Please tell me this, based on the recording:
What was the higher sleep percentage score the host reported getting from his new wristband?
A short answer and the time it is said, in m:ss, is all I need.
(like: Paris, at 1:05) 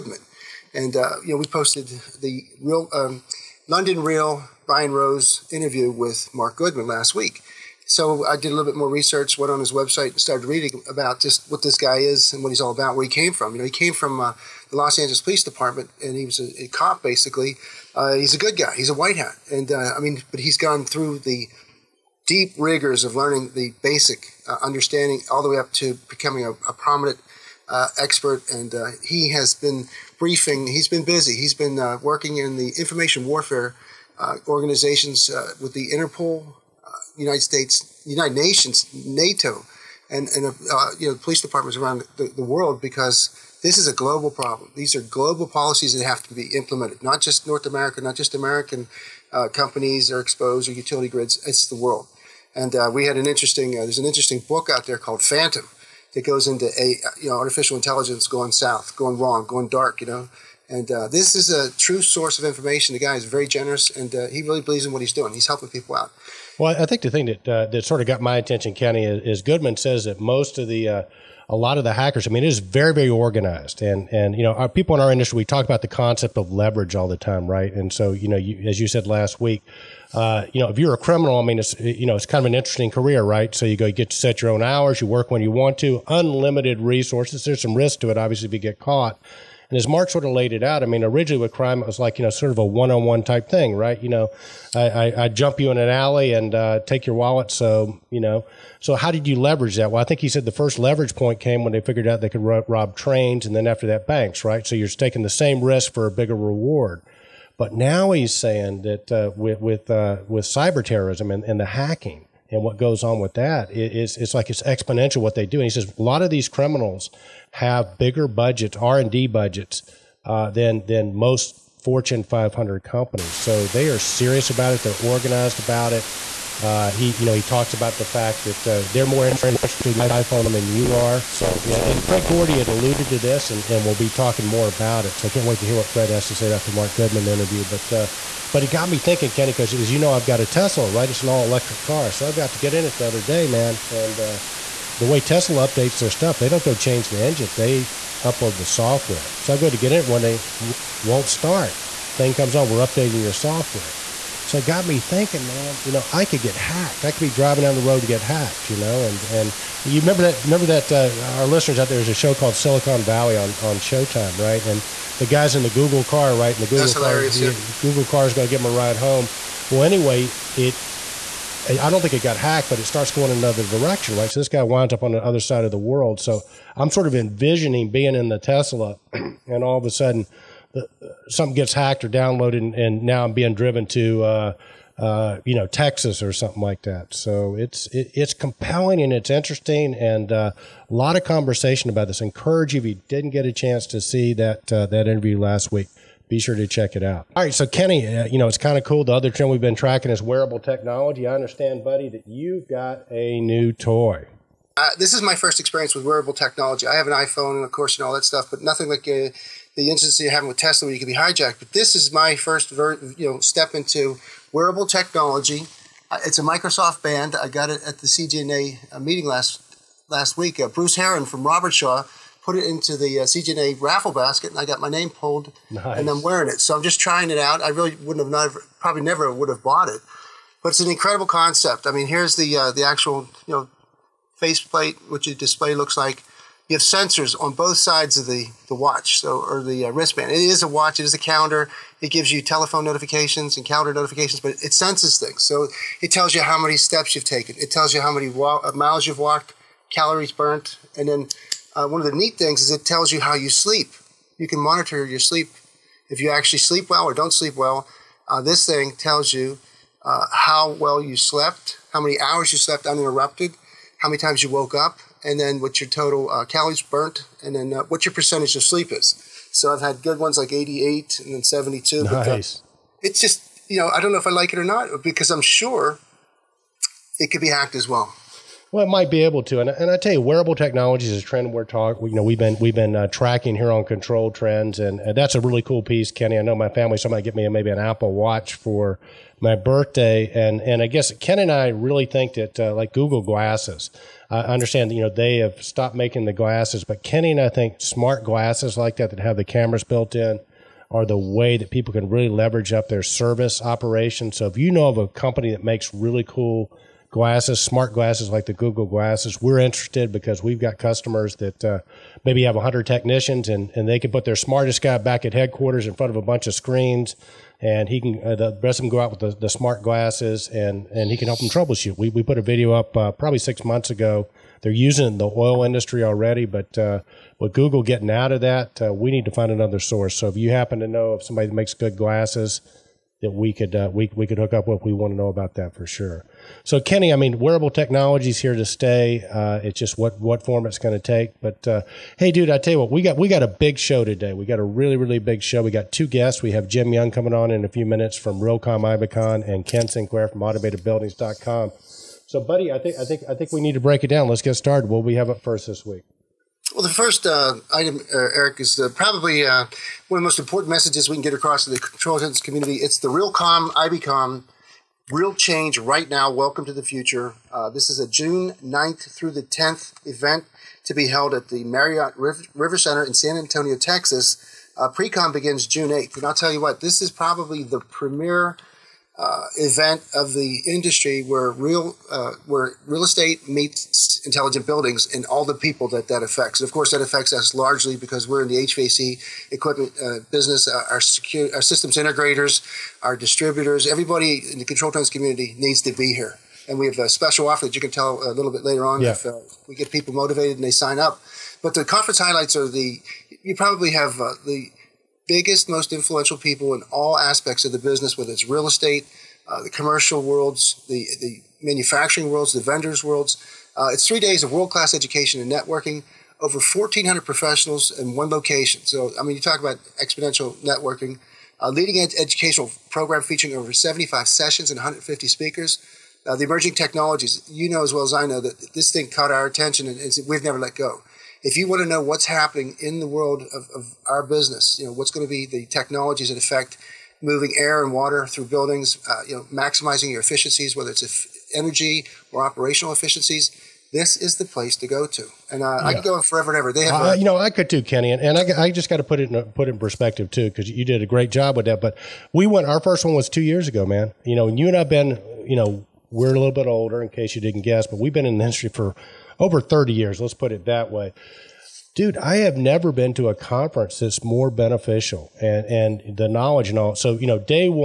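88, at 4:30.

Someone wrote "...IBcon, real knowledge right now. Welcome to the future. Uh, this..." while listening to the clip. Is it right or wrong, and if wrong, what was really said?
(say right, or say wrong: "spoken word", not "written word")
wrong: "change", not "knowledge".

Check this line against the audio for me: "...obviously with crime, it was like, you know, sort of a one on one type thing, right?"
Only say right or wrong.
wrong.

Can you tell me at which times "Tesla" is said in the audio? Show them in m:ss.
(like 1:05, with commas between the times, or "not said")
2:20, 2:25, 2:58, 3:30.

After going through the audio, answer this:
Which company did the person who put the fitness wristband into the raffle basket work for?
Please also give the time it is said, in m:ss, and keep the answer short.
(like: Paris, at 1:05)
Robertshaw, at 3:41.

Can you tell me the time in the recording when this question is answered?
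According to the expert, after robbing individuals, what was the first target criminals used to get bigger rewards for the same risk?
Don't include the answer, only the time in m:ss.
1:42.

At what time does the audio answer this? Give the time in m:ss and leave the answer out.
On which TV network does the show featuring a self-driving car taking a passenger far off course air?
2:43.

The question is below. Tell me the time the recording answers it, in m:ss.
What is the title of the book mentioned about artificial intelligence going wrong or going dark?
0:55.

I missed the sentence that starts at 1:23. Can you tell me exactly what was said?
So you go, you get to set your own hours, you work when you want to, unlimited resources.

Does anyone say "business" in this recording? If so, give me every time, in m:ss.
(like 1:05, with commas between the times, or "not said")
6:30, 6:47, 7:14.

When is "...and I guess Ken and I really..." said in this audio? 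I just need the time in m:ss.
4:50.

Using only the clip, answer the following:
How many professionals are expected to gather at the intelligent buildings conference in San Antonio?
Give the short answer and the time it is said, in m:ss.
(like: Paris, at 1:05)
1,400, at 6:56.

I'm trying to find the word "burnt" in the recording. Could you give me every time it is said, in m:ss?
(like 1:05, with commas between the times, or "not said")
4:10, 4:26.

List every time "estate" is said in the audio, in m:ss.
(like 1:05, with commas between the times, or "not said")
6:23, 6:48.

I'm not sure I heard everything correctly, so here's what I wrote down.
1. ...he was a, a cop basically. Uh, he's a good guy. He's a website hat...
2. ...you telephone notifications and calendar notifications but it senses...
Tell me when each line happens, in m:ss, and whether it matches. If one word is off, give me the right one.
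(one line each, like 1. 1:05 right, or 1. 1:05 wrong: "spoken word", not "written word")
1. 0:16 wrong: "white", not "website"
2. 4:02 right.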